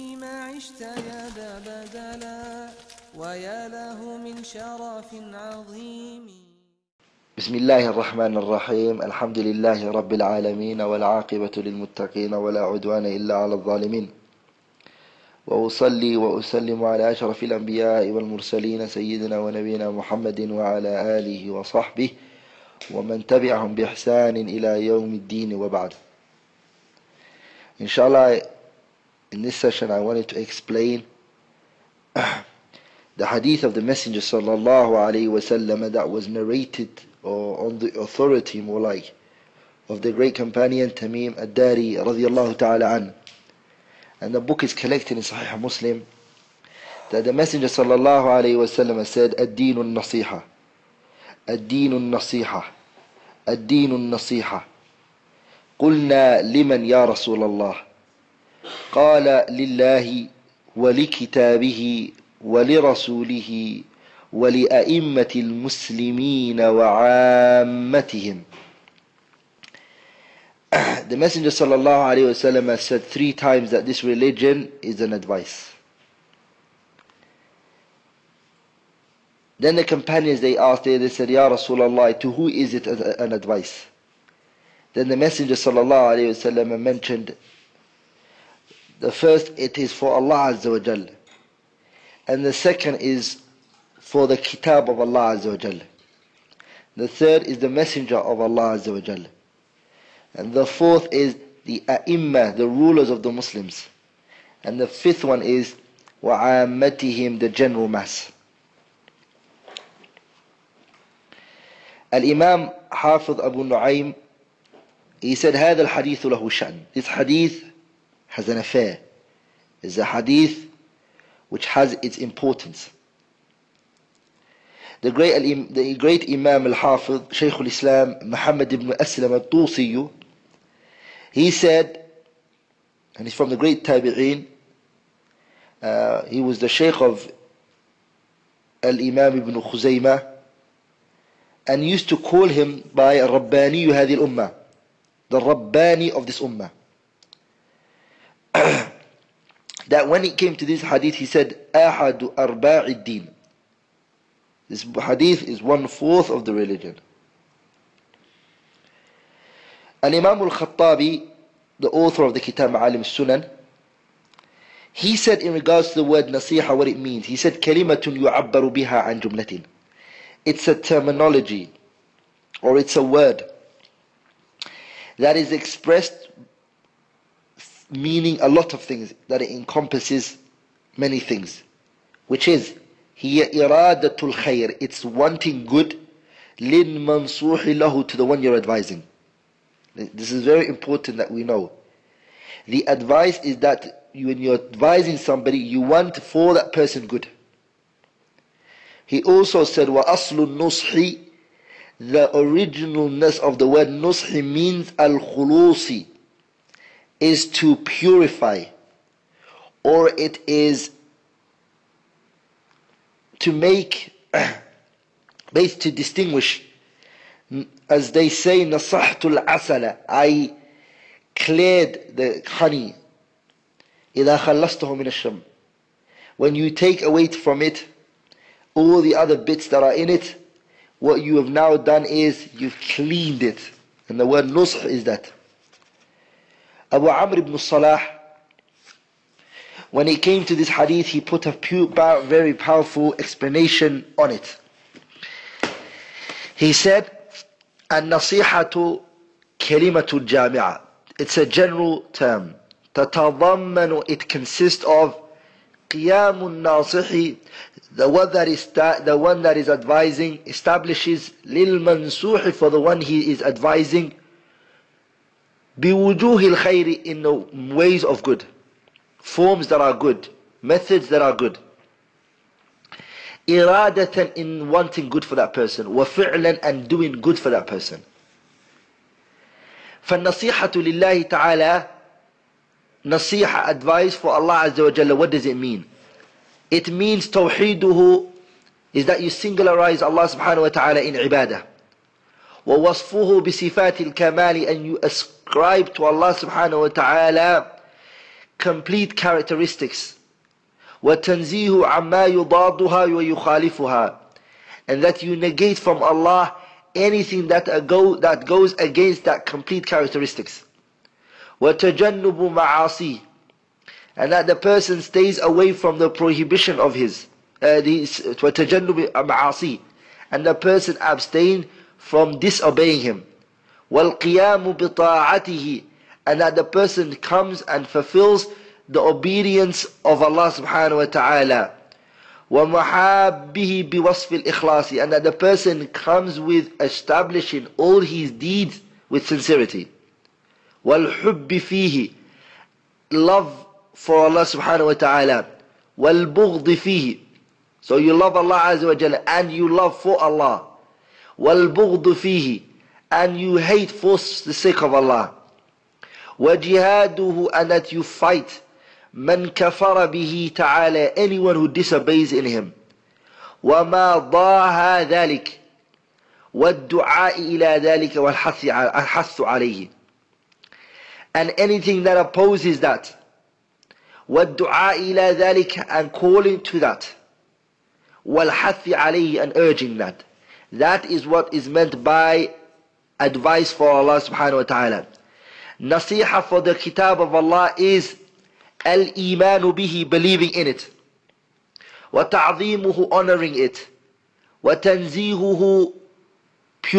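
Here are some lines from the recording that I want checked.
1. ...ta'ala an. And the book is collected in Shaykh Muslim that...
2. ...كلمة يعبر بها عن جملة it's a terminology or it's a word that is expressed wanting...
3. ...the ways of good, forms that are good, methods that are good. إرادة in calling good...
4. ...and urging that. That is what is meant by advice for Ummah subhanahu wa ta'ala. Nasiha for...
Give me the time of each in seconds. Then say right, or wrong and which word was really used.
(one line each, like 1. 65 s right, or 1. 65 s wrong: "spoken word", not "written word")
1. 42 s wrong: "Sahih", not "Shaykh"
2. 167 s wrong: "meaning", not "wanting"
3. 267 s wrong: "wanting", not "calling"
4. 379 s wrong: "Allah", not "Ummah".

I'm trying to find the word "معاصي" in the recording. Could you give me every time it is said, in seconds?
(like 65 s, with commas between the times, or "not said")
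312 s, 319 s.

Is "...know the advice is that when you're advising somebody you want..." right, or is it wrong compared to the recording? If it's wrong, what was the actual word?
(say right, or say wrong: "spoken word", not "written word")
right.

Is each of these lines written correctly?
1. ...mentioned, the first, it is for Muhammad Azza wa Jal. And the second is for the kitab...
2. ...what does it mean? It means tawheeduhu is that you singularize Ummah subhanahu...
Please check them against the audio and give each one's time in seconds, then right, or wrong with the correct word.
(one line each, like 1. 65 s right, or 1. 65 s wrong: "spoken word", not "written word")
1. 86 s wrong: "Allah", not "Muhammad"
2. 285 s wrong: "Allah", not "Ummah".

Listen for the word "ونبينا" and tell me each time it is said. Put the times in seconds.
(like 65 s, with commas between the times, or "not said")
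19 s.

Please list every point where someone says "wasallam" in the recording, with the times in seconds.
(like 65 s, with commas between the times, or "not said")
35 s, 48 s.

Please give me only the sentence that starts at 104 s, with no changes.
And the fifth one is وَعَامَّتِهِمْ the general mass.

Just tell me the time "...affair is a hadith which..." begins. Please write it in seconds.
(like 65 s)
118 s.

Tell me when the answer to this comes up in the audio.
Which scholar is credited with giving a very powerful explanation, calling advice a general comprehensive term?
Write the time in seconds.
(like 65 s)
236 s.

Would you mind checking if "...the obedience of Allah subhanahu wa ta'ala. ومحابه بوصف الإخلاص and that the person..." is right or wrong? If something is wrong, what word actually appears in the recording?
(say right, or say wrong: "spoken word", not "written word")
right.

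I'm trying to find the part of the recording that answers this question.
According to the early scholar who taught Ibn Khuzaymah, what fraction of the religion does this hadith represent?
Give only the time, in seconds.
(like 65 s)
155 s.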